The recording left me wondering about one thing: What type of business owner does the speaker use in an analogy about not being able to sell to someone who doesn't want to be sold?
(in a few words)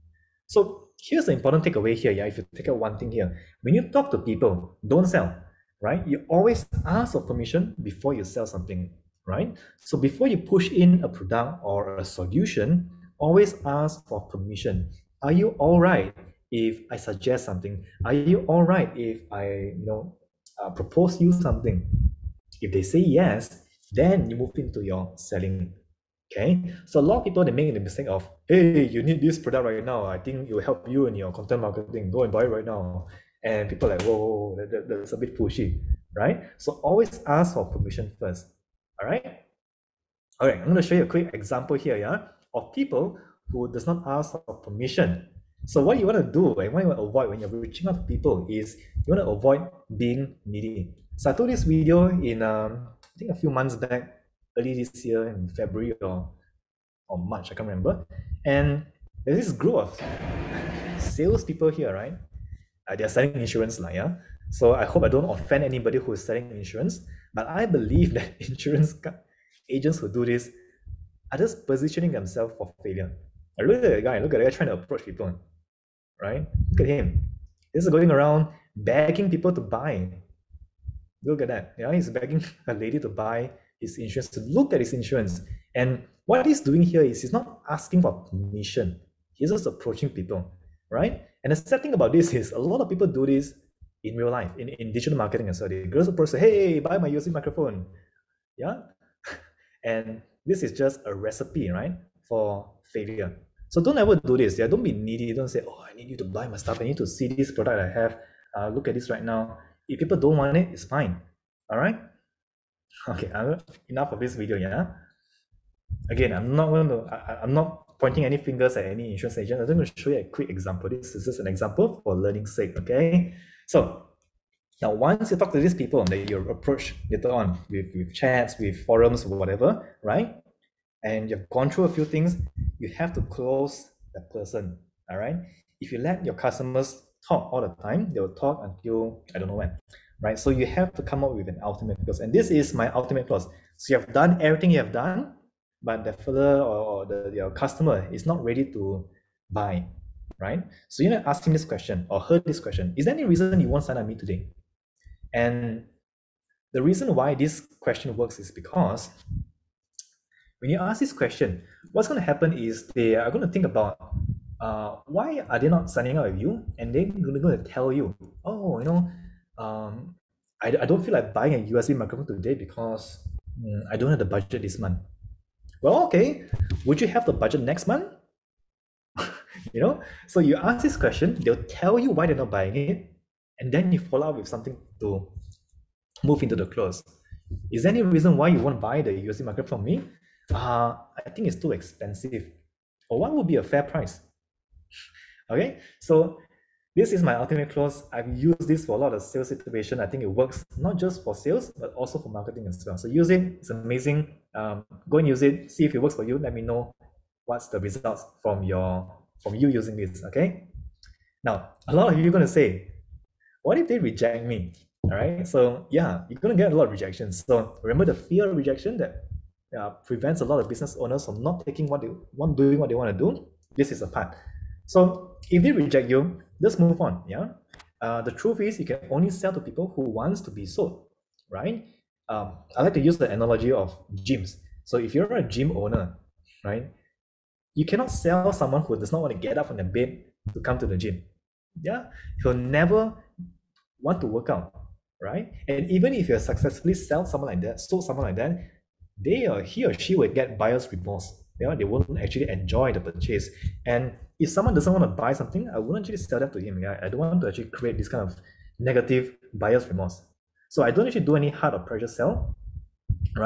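gym owner.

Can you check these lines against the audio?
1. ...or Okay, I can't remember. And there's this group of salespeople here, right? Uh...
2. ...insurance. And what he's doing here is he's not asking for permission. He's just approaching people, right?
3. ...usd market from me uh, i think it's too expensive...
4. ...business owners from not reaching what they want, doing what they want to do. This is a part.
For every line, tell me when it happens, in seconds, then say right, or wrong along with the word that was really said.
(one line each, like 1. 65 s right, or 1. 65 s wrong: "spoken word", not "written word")
1. 57 s wrong: "March", not "Okay"
2. 84 s right
3. 189 s right
4. 220 s wrong: "taking", not "reaching".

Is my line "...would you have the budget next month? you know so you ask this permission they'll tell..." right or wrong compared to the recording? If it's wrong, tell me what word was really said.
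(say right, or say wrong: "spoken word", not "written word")
wrong: "question", not "permission".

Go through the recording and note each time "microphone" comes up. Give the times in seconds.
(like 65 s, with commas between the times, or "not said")
97 s, 171 s.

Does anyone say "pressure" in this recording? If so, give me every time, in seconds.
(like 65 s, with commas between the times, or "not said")
261 s.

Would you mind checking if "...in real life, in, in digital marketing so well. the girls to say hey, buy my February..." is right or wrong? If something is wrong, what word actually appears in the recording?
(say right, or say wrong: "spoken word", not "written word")
wrong: "USB", not "February".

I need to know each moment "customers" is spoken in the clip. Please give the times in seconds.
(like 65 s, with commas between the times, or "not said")
136 s, 147 s.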